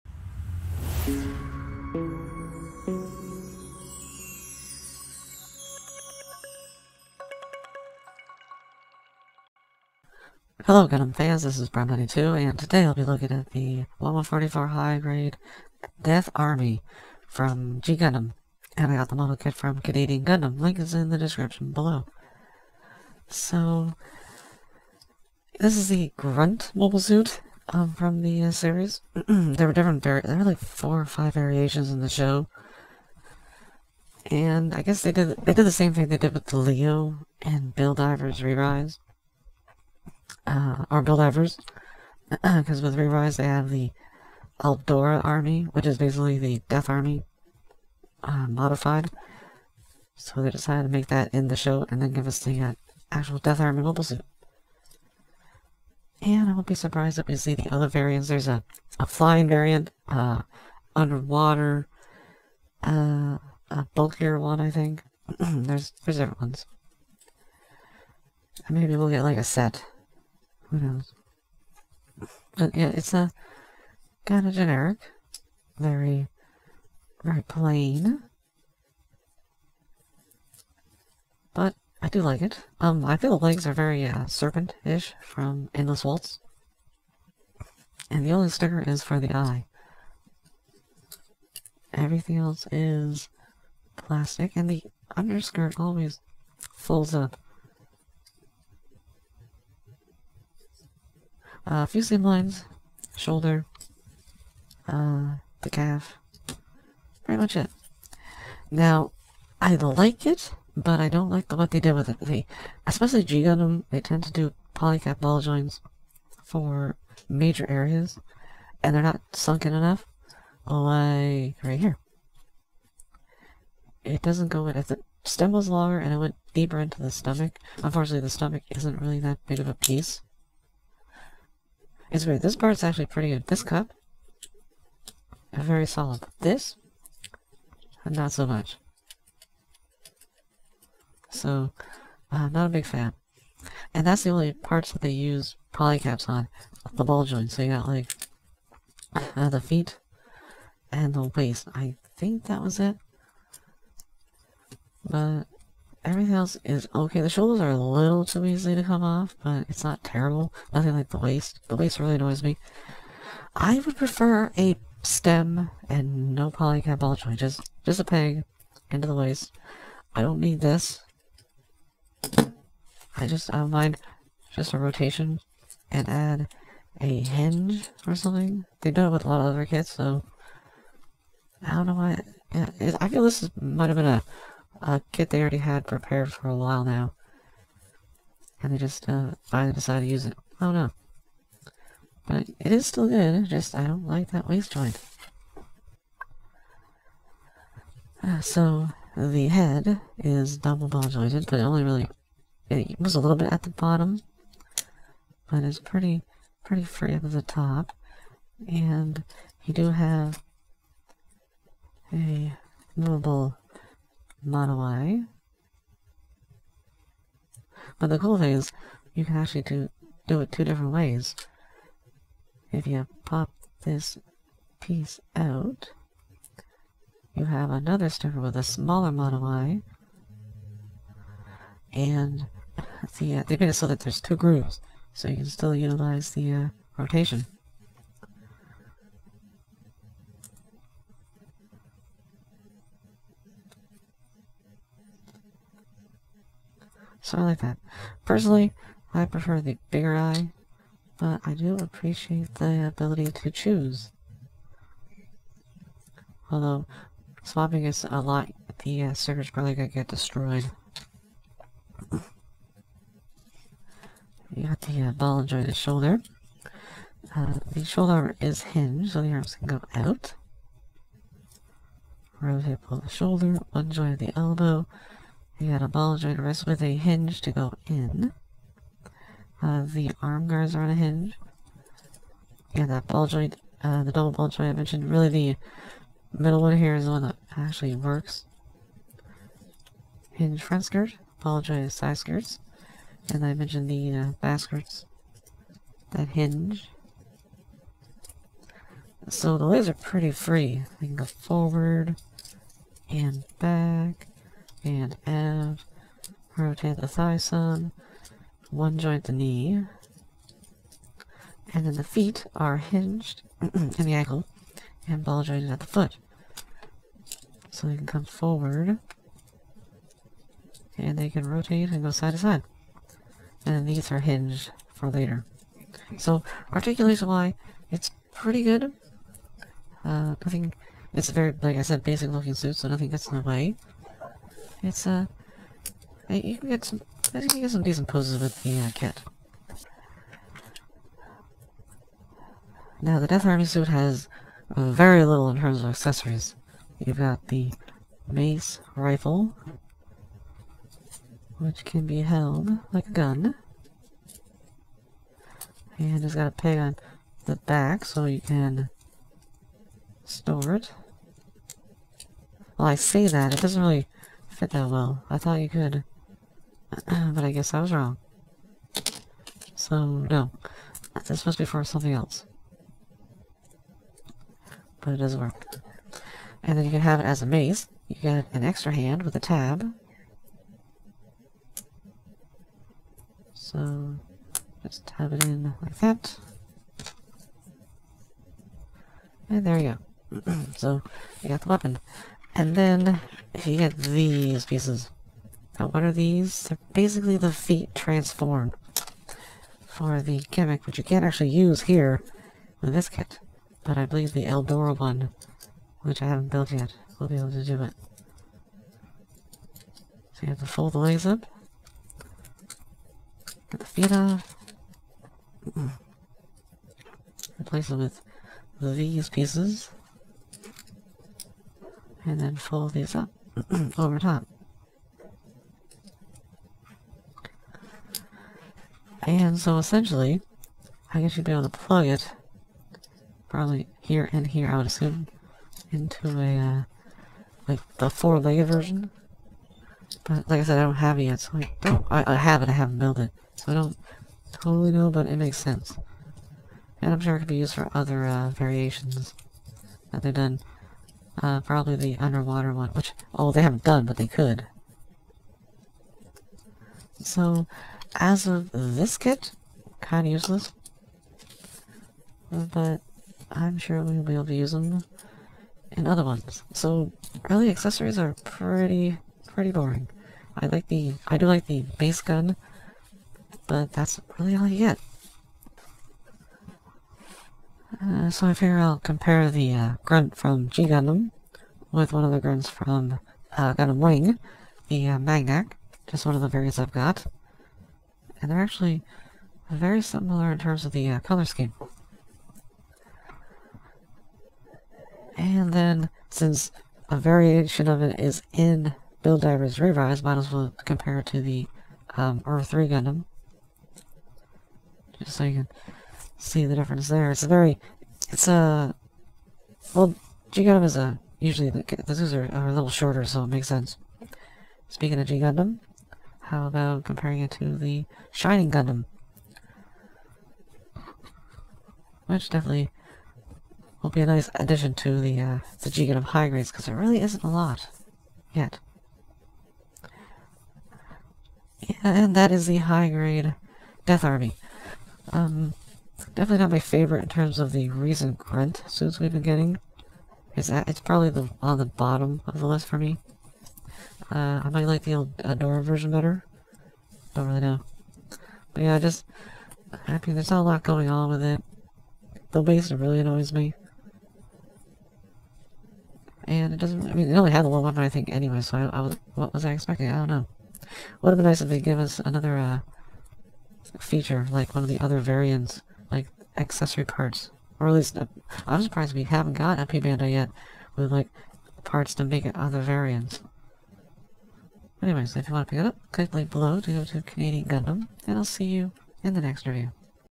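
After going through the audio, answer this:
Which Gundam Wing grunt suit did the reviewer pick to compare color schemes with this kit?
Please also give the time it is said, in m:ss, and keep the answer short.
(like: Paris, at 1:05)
Maganac, at 8:05.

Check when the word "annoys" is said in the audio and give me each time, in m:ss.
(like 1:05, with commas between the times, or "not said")
2:42, 9:13.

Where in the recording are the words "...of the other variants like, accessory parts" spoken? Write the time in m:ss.
9:24.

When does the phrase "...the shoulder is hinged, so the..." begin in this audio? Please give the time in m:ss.
4:27.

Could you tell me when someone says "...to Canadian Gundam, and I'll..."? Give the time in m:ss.
9:37.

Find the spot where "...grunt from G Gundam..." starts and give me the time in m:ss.
8:00.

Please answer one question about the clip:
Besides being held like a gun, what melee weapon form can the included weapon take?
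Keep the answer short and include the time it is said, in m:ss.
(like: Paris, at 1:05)
mace, at 6:17.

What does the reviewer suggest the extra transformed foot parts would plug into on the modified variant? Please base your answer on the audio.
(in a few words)
four-legged version.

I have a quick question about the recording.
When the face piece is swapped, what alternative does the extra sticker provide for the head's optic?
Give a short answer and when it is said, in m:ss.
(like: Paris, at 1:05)
smaller mono-eye, at 3:48.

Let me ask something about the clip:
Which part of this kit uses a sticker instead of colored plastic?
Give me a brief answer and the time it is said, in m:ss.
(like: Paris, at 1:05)
the eye, at 1:29.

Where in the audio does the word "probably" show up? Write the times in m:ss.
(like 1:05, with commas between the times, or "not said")
4:19, 7:13, 7:31, 9:01.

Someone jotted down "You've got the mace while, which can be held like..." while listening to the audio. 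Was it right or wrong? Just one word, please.
wrong.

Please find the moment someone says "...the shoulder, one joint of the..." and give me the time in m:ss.
4:32.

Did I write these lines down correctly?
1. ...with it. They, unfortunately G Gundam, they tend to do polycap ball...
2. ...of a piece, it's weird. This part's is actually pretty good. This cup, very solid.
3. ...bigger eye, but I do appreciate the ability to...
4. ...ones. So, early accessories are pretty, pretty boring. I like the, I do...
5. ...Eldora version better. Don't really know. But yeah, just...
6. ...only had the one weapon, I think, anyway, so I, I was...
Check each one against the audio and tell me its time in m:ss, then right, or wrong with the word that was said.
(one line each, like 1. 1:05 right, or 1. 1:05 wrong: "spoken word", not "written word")
1. 1:51 wrong: "especially", not "unfortunately"
2. 2:09 right
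3. 4:09 right
4. 7:46 right
5. 9:05 right
6. 9:17 right.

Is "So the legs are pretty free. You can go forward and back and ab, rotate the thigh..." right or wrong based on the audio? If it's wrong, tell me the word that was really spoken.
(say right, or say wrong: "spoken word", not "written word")
right.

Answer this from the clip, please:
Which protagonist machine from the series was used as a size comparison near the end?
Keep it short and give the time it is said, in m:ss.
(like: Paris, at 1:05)
Shining Gundam, at 8:38.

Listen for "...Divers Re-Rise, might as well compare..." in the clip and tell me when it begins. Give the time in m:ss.
8:19.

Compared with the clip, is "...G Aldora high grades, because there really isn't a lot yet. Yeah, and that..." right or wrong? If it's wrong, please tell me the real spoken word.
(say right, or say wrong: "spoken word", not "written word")
wrong: "Gundam", not "Aldora".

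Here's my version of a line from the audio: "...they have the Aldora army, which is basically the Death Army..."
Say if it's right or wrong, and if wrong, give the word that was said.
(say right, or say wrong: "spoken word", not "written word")
right.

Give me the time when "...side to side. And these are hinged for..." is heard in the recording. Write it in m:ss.
5:22.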